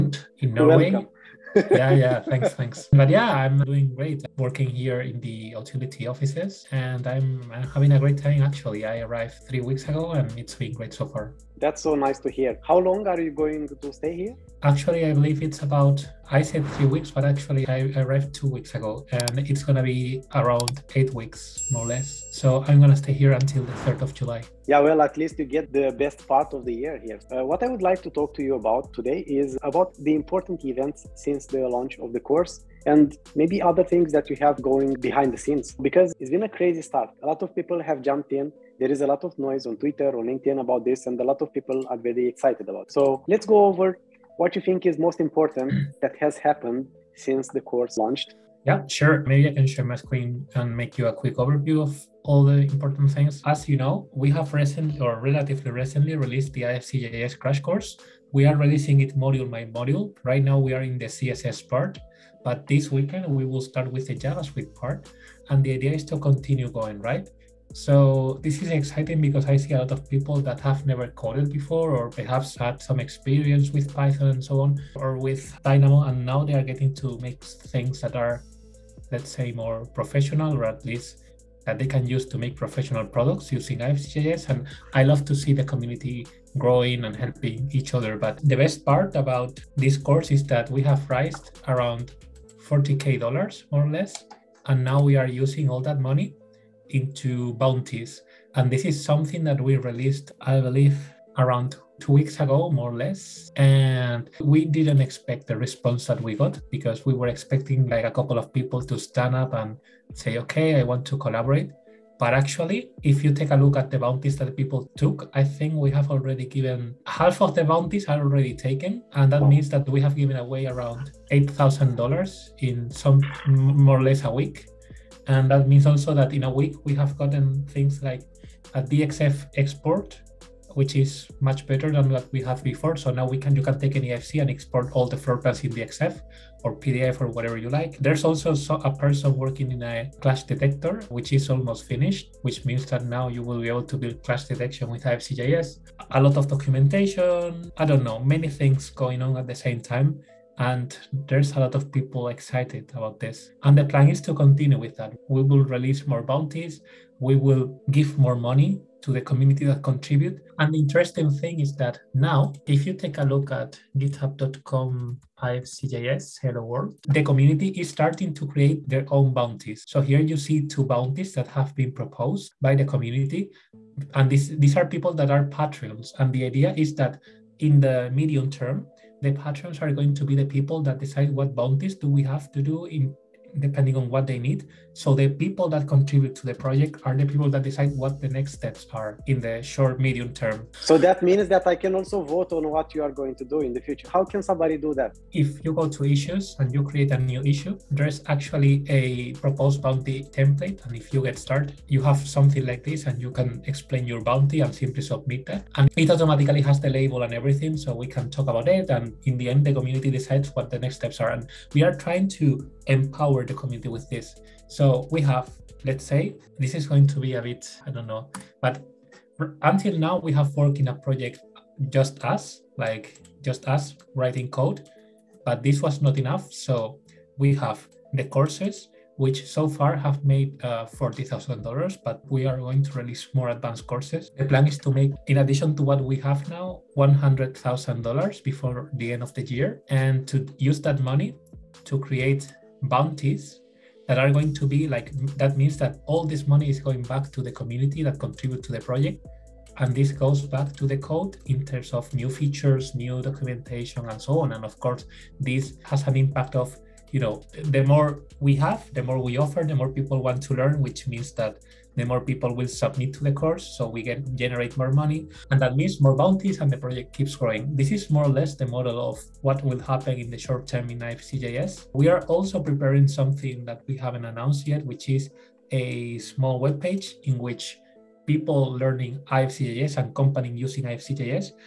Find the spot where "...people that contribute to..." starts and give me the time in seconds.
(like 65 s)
185 s.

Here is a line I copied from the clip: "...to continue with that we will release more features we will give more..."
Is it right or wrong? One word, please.
wrong.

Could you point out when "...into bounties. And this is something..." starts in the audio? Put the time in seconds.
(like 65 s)
96 s.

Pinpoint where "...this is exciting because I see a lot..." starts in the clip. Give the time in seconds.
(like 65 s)
68 s.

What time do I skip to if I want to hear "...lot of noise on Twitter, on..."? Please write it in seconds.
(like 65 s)
39 s.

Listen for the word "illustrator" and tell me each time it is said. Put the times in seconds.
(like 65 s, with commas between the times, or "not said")
not said.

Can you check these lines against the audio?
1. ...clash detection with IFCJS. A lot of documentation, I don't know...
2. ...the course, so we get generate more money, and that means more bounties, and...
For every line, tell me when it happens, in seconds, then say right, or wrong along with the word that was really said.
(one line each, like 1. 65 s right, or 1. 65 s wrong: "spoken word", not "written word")
1. 144 s right
2. 263 s right.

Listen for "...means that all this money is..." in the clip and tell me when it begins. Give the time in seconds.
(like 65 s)
245 s.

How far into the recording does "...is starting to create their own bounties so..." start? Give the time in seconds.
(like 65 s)
167 s.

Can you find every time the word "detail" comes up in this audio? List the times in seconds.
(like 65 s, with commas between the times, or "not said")
not said.